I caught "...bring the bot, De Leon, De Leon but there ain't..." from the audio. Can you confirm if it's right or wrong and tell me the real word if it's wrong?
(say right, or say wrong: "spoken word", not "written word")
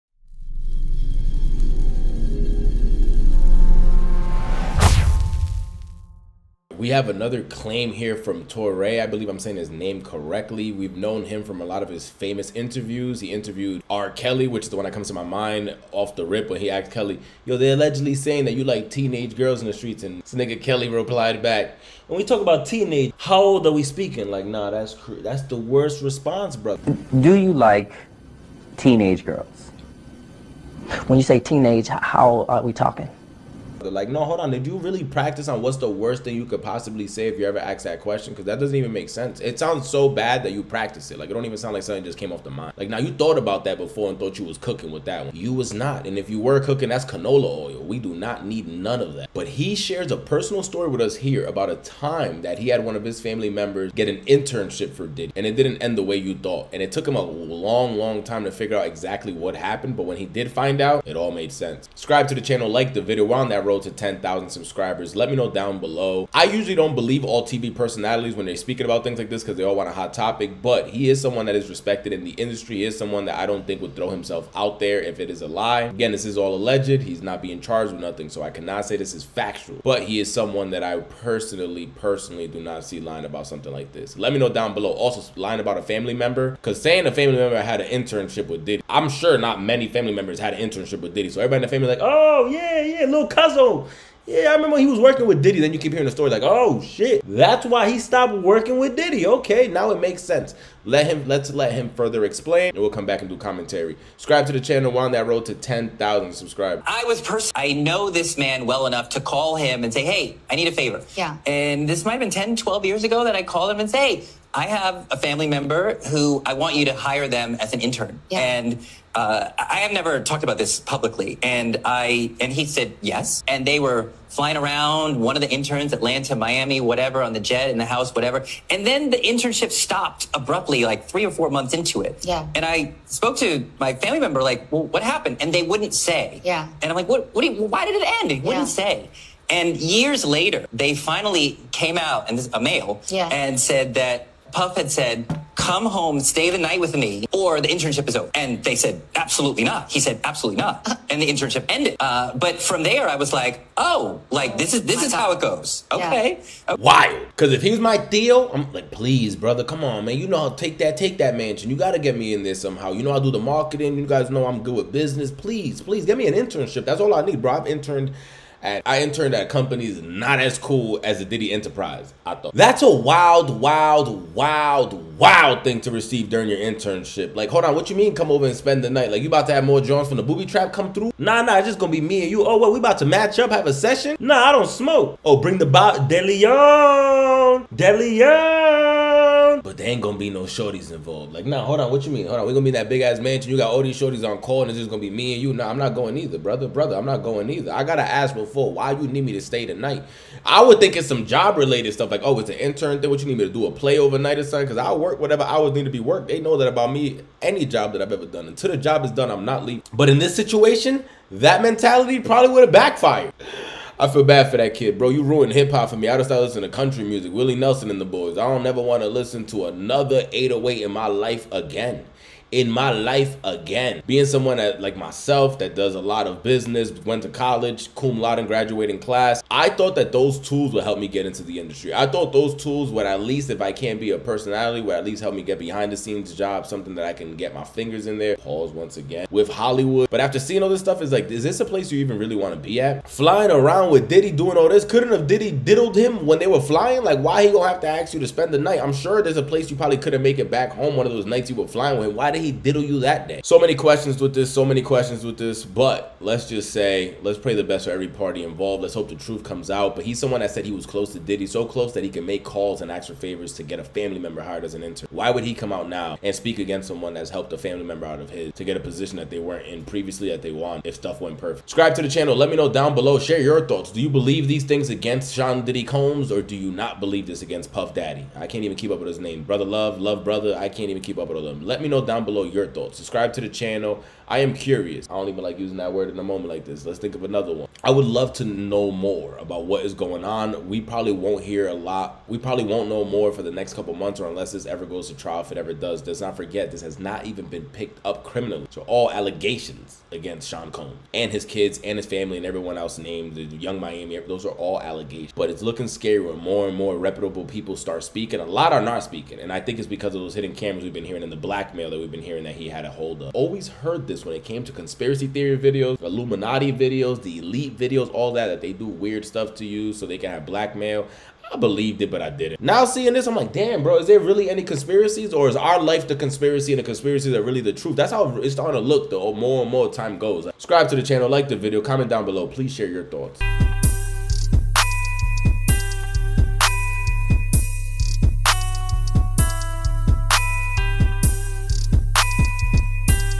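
right.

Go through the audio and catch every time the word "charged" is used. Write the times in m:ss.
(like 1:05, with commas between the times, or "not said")
1:17.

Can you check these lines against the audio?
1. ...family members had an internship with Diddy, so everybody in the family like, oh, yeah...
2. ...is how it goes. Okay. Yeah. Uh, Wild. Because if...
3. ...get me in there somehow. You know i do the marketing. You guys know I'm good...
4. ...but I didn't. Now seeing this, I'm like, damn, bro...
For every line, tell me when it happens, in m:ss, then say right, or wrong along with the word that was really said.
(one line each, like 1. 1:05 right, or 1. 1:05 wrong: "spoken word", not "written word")
1. 1:29 right
2. 2:35 right
3. 2:41 right
4. 5:22 right.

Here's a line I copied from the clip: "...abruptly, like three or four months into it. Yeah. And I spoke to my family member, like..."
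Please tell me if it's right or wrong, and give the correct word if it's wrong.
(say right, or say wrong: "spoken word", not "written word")
right.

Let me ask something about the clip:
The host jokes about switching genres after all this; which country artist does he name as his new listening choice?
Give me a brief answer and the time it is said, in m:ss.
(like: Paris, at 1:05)
Willie Nelson, at 3:37.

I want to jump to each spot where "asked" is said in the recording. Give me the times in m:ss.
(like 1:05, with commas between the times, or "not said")
0:16, 0:37.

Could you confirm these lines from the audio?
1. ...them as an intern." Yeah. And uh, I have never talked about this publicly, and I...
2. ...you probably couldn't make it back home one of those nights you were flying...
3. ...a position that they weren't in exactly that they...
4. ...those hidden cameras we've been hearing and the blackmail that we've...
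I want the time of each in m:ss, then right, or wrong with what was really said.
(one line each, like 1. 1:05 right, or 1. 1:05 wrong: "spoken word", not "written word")
1. 1:57 right
2. 4:09 right
3. 4:28 wrong: "previously", not "exactly"
4. 5:10 right.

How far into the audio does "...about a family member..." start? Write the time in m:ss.
1:25.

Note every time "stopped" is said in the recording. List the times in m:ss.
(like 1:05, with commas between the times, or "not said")
1:37, 2:09.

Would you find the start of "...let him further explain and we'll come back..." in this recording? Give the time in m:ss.
1:41.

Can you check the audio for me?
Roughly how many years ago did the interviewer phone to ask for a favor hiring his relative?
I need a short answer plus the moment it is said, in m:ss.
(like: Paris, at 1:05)
10 to 12 years, at 1:52.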